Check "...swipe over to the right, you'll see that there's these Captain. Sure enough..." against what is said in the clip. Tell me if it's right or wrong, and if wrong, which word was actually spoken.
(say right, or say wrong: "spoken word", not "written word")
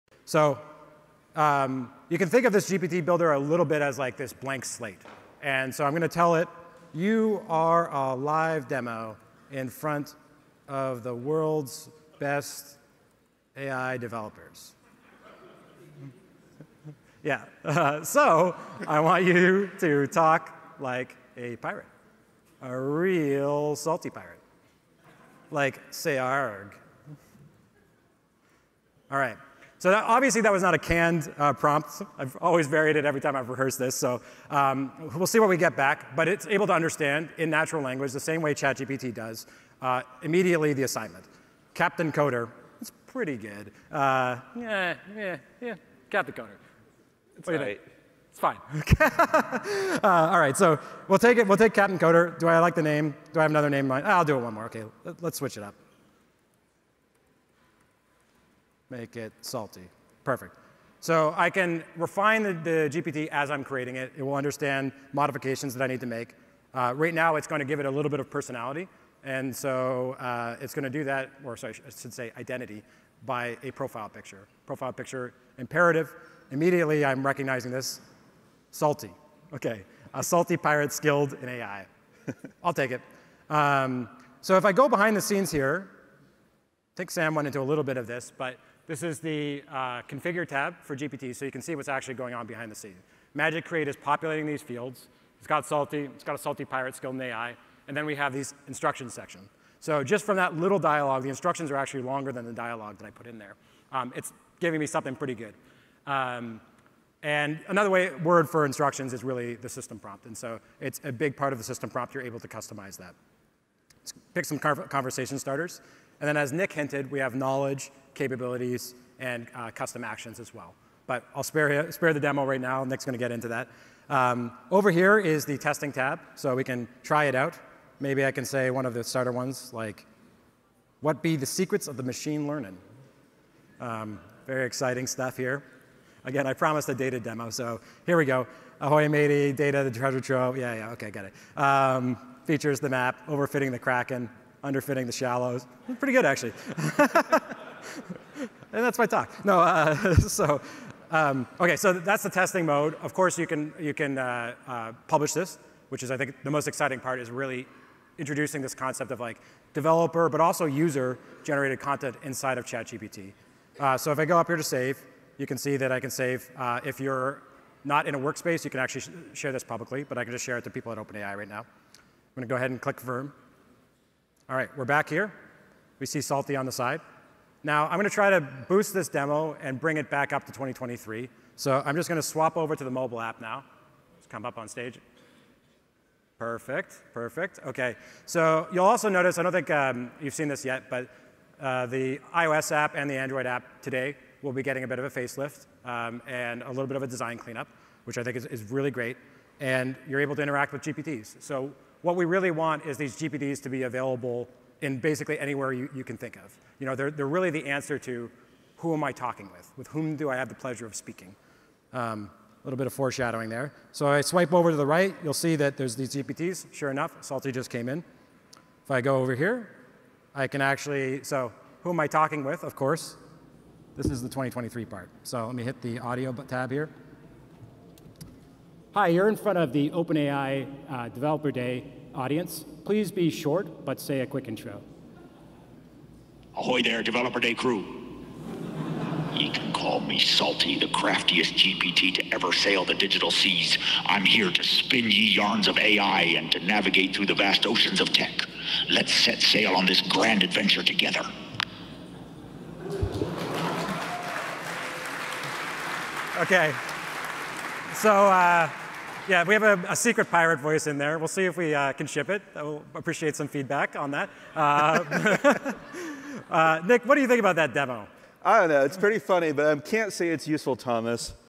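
wrong: "GPTs", not "Captain".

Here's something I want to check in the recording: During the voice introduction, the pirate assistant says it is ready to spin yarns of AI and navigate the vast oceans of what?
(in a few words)
tech.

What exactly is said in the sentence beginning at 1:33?
Magic Create is populating these fields.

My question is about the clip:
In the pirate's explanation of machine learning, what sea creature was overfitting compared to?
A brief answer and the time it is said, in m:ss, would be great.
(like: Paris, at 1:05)
the Kraken, at 2:23.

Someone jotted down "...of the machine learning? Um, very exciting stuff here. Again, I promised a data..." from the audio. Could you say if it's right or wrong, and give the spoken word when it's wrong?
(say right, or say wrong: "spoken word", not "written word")
right.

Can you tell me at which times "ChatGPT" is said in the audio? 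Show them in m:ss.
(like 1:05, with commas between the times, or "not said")
0:38, 2:42.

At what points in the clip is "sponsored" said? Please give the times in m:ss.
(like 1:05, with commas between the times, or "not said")
not said.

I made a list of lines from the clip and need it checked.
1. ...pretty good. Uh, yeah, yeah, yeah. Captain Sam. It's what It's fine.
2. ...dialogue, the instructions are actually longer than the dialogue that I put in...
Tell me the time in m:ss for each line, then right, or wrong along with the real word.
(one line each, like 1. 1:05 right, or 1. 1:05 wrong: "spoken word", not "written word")
1. 0:43 wrong: "Coder", not "Sam"
2. 1:40 right.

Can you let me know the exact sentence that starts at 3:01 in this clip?
So I'm just going to swap over to the mobile app now.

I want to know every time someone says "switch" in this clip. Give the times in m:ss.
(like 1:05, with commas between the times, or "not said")
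0:55.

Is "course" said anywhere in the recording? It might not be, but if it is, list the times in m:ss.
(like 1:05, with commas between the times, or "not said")
2:33, 3:42.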